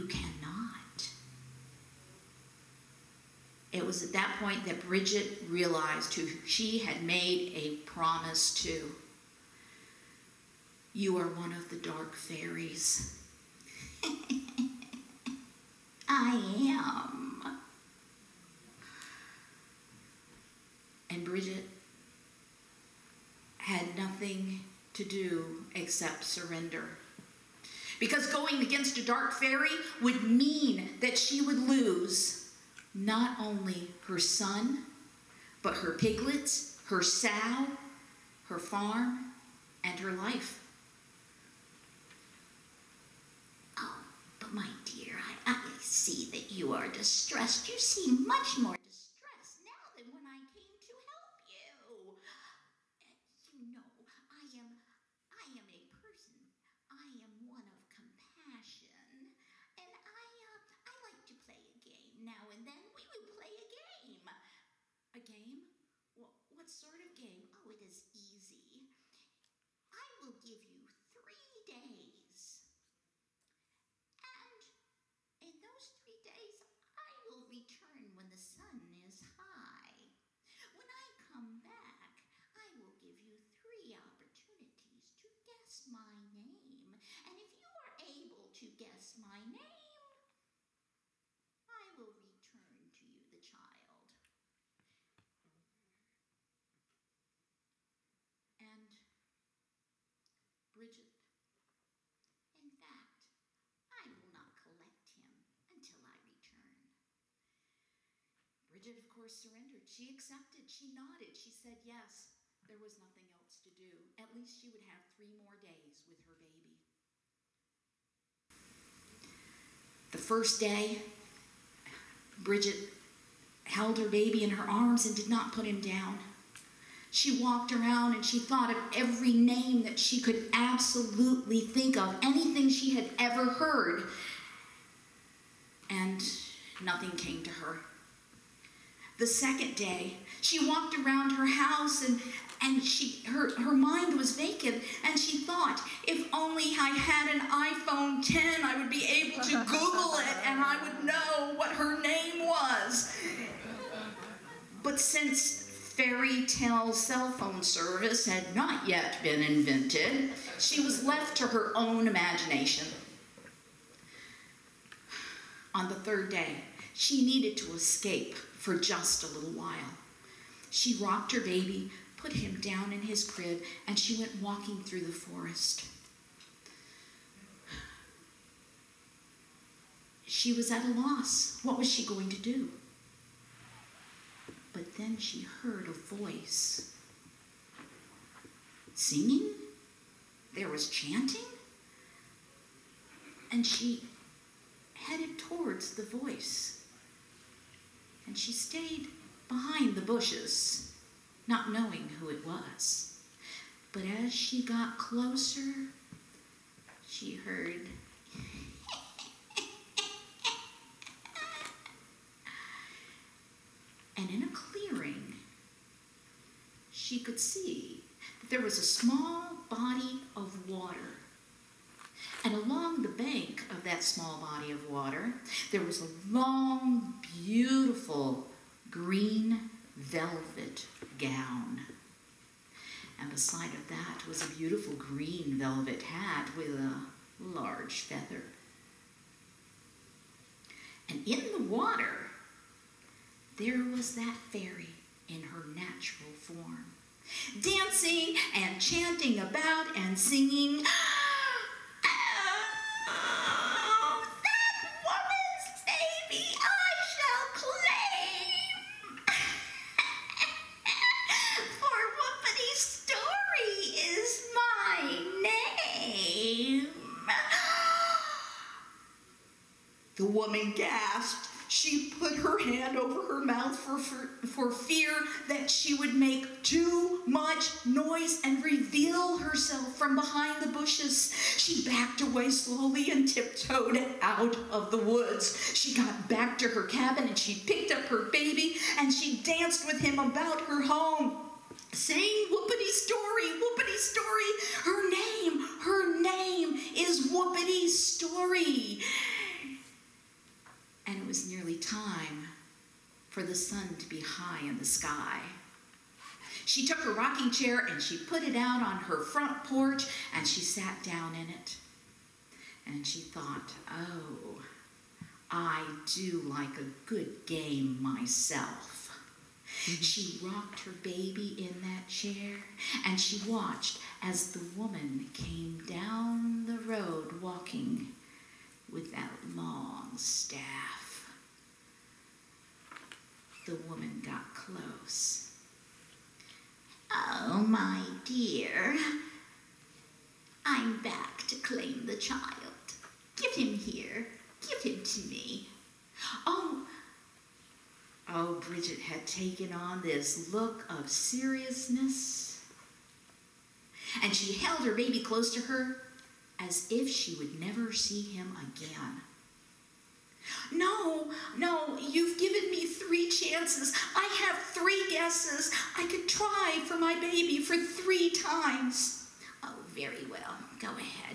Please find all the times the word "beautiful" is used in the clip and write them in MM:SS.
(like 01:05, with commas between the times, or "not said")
03:47, 03:54.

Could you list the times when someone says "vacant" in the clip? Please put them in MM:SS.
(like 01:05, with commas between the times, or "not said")
02:24.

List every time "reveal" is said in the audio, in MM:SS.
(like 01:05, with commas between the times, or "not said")
04:38.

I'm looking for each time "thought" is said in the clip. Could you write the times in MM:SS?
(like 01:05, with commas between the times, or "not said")
02:08, 02:25, 05:13.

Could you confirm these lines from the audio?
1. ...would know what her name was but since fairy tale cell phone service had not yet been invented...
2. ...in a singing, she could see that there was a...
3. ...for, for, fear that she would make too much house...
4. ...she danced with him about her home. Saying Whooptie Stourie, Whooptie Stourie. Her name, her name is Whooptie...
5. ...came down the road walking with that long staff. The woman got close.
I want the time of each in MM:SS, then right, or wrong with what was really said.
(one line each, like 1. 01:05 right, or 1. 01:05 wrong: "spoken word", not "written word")
1. 02:30 right
2. 03:34 wrong: "clearing", not "singing"
3. 04:33 wrong: "noise", not "house"
4. 04:49 right
5. 05:25 right.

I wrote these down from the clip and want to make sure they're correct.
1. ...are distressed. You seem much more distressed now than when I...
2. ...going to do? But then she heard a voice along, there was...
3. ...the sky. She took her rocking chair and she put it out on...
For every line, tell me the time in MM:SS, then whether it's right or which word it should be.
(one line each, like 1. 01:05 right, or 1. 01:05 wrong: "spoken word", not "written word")
1. 00:46 right
2. 03:02 wrong: "singing", not "along"
3. 05:04 right.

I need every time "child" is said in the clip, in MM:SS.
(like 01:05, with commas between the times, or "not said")
01:33, 05:42.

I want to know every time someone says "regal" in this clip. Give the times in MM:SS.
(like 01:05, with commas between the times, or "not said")
not said.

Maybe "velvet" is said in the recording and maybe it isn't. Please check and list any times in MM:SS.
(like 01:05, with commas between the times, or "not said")
03:49, 03:55.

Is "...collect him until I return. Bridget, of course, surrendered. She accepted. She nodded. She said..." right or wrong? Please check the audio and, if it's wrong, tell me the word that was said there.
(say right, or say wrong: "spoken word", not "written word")
right.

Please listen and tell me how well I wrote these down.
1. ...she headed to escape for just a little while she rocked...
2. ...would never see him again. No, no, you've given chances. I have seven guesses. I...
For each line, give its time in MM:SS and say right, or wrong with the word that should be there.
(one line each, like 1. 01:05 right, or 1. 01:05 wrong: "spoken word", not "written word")
1. 02:46 wrong: "needed", not "headed"
2. 05:57 wrong: "three", not "seven".